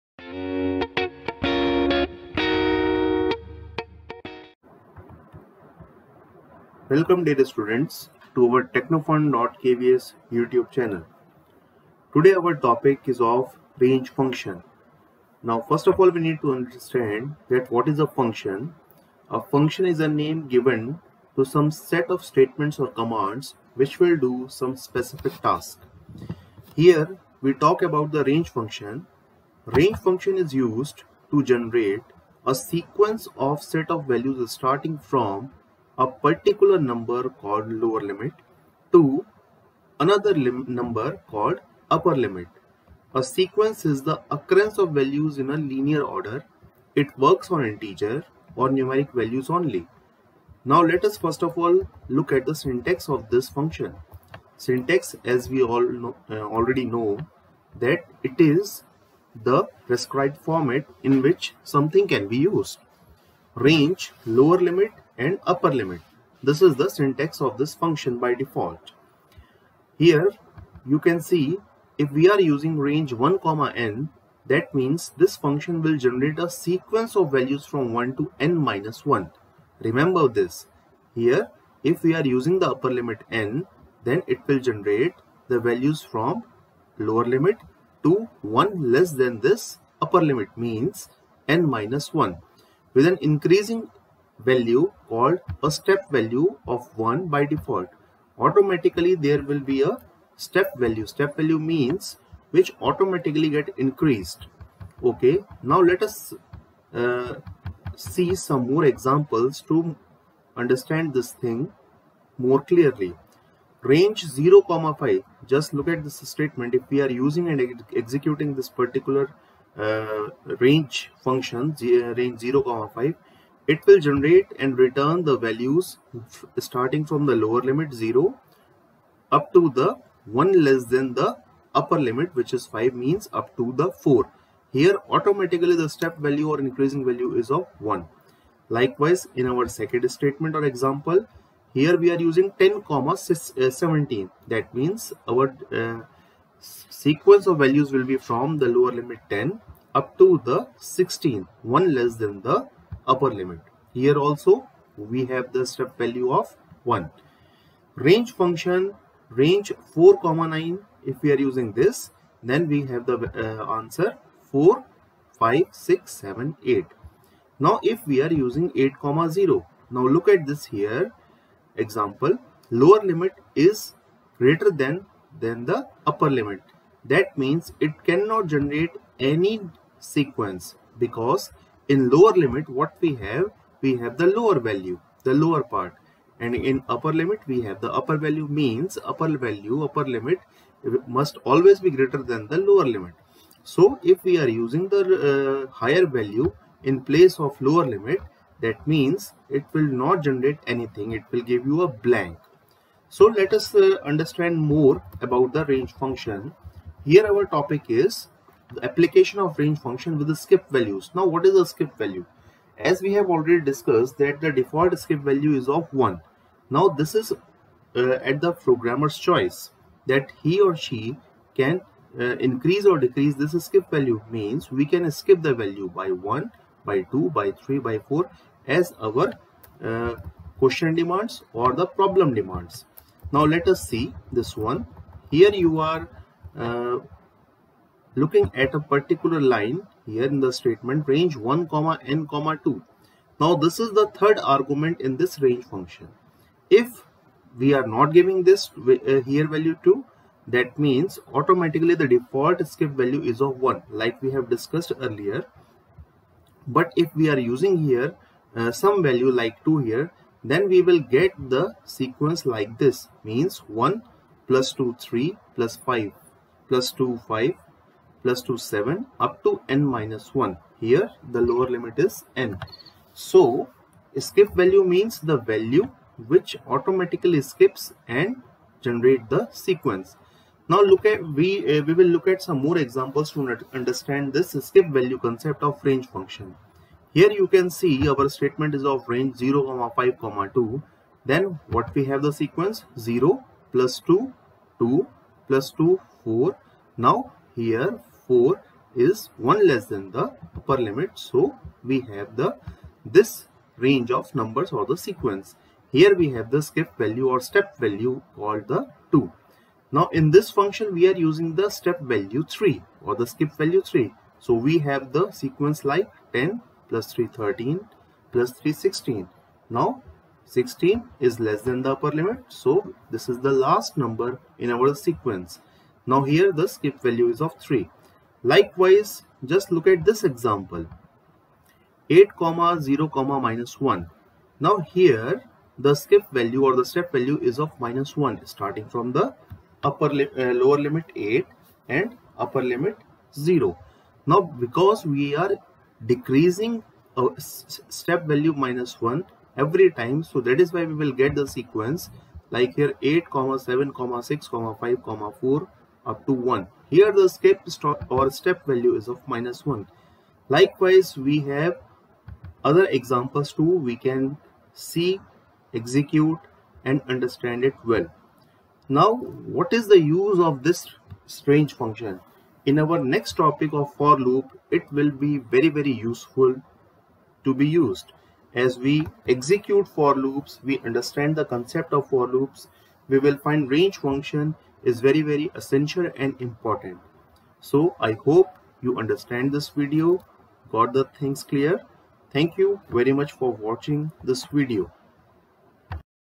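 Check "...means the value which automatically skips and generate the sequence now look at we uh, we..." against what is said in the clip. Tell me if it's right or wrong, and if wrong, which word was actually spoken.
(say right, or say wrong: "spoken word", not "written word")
right.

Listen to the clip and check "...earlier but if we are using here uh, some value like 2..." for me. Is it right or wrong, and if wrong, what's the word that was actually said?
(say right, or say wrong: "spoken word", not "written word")
right.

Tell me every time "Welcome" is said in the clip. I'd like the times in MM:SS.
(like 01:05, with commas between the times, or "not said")
00:06.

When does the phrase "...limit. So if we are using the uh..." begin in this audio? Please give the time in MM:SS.
03:12.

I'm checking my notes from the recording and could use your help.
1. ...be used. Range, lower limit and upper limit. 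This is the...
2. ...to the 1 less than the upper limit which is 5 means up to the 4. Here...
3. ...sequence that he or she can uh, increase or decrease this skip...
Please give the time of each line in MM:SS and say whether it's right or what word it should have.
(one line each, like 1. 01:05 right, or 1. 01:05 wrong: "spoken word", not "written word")
1. 01:02 right
2. 02:09 right
3. 03:39 wrong: "choice", not "sequence".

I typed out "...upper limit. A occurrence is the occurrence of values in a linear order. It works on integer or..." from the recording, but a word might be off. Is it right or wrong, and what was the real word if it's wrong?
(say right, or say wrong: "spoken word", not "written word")
wrong: "sequence", not "occurrence".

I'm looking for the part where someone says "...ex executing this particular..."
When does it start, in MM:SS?
01:57.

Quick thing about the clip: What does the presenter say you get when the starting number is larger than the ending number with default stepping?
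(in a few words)
A blank.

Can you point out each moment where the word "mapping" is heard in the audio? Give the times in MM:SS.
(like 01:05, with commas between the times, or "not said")
not said.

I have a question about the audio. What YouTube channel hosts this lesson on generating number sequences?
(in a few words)
technofun.kvs.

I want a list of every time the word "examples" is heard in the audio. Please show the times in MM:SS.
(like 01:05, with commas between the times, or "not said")
01:48, 02:20, 02:51, 04:42, 05:30, 06:02.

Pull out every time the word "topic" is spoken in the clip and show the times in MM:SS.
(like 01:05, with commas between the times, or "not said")
00:12, 03:27, 06:13.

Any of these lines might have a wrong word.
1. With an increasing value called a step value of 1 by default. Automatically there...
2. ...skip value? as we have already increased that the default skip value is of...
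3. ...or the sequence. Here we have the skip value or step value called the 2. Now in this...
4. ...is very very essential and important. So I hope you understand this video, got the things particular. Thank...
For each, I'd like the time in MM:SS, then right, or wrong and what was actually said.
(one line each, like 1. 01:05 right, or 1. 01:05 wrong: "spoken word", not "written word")
1. 01:32 right
2. 03:31 wrong: "discussed", not "increased"
3. 05:04 right
4. 06:24 wrong: "clear", not "particular".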